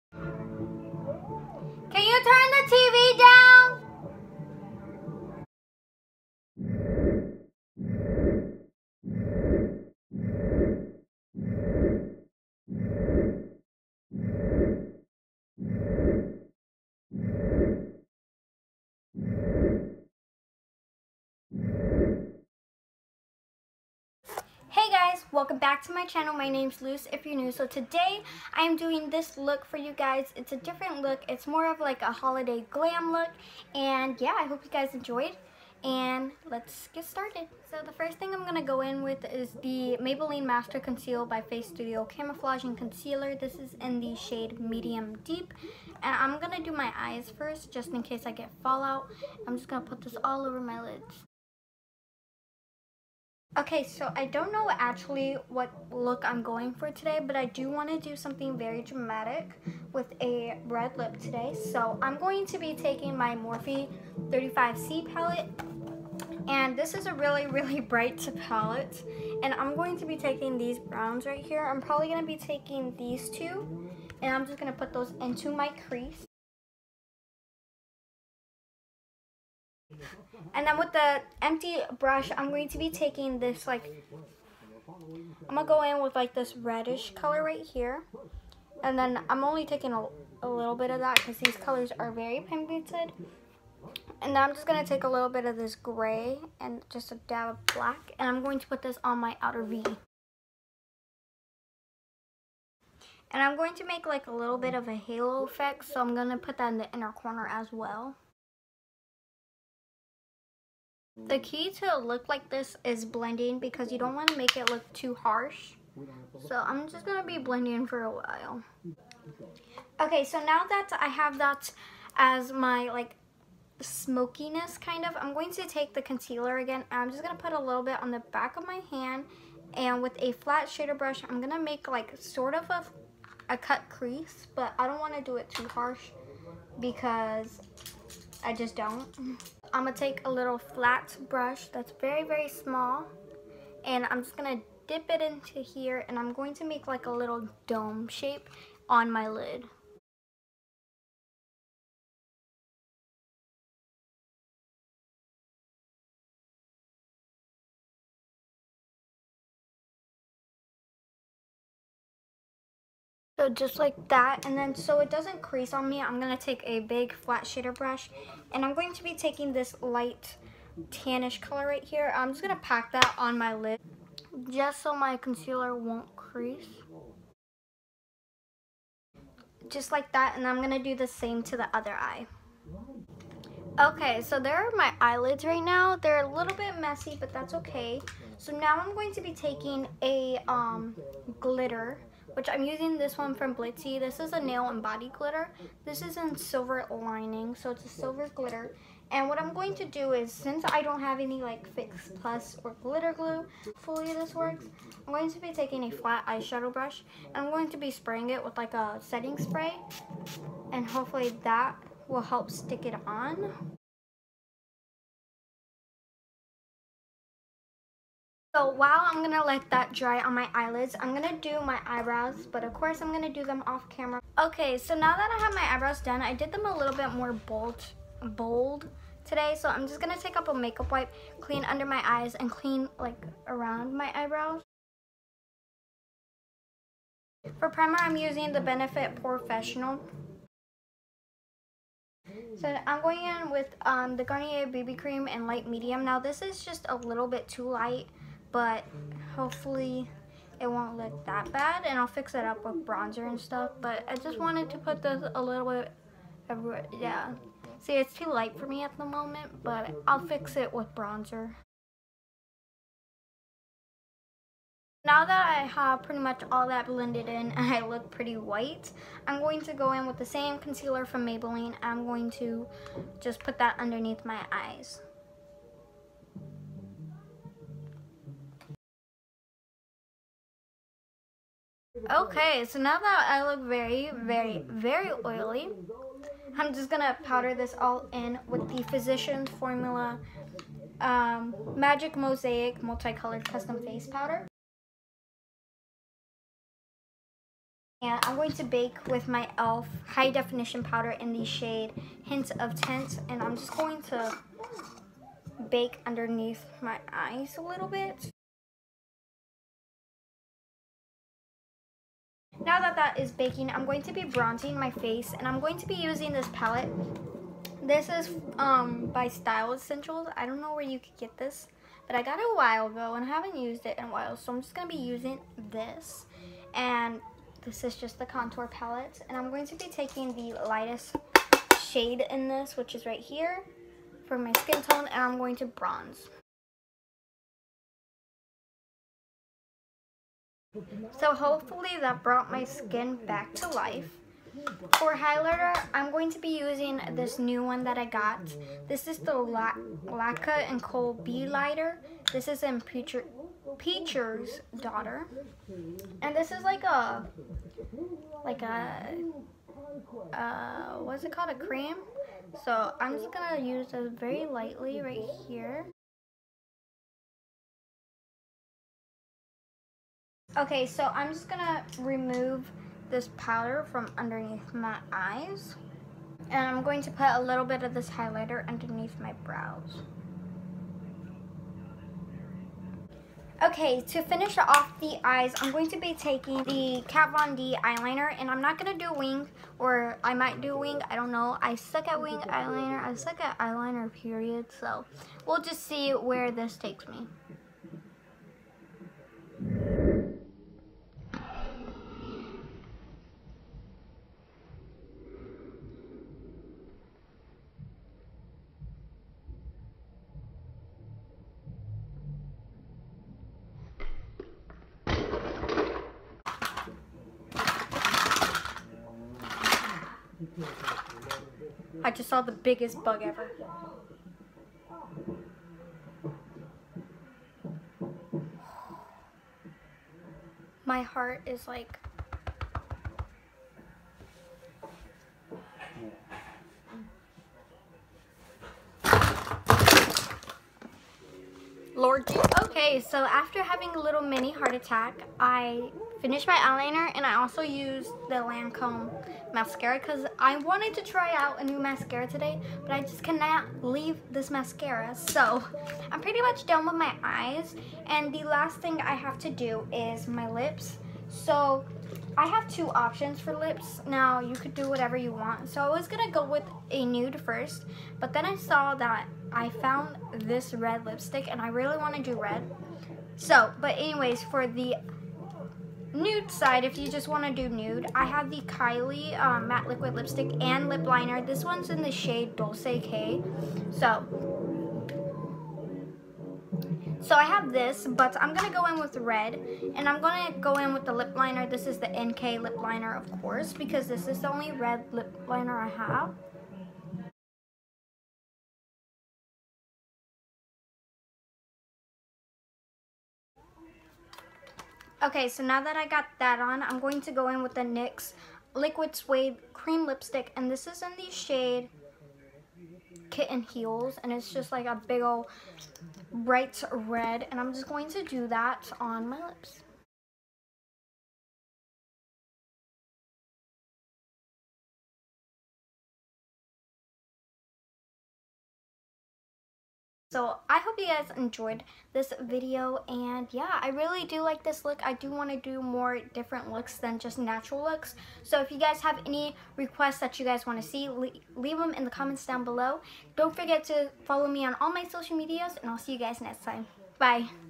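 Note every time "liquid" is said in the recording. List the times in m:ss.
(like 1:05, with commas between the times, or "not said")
7:59, 8:28.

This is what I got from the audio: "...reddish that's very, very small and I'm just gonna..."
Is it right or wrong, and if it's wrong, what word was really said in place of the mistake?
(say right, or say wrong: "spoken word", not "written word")
wrong: "brush", not "reddish".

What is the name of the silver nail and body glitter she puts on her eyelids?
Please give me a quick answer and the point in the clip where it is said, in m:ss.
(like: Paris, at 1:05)
Silver Lining, at 3:16.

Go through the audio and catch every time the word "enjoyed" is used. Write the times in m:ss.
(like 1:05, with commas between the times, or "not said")
0:34, 8:51.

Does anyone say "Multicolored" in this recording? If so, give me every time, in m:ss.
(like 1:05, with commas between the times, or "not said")
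4:52.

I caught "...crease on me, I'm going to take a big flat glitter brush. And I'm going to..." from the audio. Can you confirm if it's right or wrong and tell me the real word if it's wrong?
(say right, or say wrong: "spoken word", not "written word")
wrong: "shader", not "glitter".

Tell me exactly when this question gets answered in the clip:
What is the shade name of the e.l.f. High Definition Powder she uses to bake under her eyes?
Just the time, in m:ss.
5:02.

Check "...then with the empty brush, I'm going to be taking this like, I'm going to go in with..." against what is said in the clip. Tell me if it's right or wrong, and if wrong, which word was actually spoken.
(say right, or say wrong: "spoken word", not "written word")
right.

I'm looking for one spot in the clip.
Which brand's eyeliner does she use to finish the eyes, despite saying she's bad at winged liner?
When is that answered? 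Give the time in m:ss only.
6:27.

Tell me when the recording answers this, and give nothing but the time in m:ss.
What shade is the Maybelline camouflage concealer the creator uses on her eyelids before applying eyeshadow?
0:44.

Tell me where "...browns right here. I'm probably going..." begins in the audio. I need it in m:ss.
1:10.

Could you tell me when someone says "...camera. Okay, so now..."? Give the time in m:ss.
3:43.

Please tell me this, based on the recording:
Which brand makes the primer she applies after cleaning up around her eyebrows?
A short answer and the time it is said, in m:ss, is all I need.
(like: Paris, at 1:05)
Benefit, at 3:58.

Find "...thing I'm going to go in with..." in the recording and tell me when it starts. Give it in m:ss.
0:38.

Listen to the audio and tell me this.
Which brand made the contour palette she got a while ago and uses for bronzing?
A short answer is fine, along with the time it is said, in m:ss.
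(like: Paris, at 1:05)
Style Essentials, at 5:19.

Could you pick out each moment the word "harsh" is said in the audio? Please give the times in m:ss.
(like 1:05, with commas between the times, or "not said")
1:55, 2:15.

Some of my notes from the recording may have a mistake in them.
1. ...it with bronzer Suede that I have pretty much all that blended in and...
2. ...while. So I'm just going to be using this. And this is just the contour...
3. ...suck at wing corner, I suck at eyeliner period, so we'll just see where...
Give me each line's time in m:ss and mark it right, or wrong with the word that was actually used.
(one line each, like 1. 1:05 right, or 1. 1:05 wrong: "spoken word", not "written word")
1. 4:20 wrong: "Now", not "Suede"
2. 5:24 right
3. 6:31 wrong: "eyeliner", not "corner".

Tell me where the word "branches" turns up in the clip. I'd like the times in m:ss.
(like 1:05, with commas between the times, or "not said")
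not said.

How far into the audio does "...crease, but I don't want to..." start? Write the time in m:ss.
2:13.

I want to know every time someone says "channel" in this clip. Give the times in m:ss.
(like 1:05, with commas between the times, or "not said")
0:26.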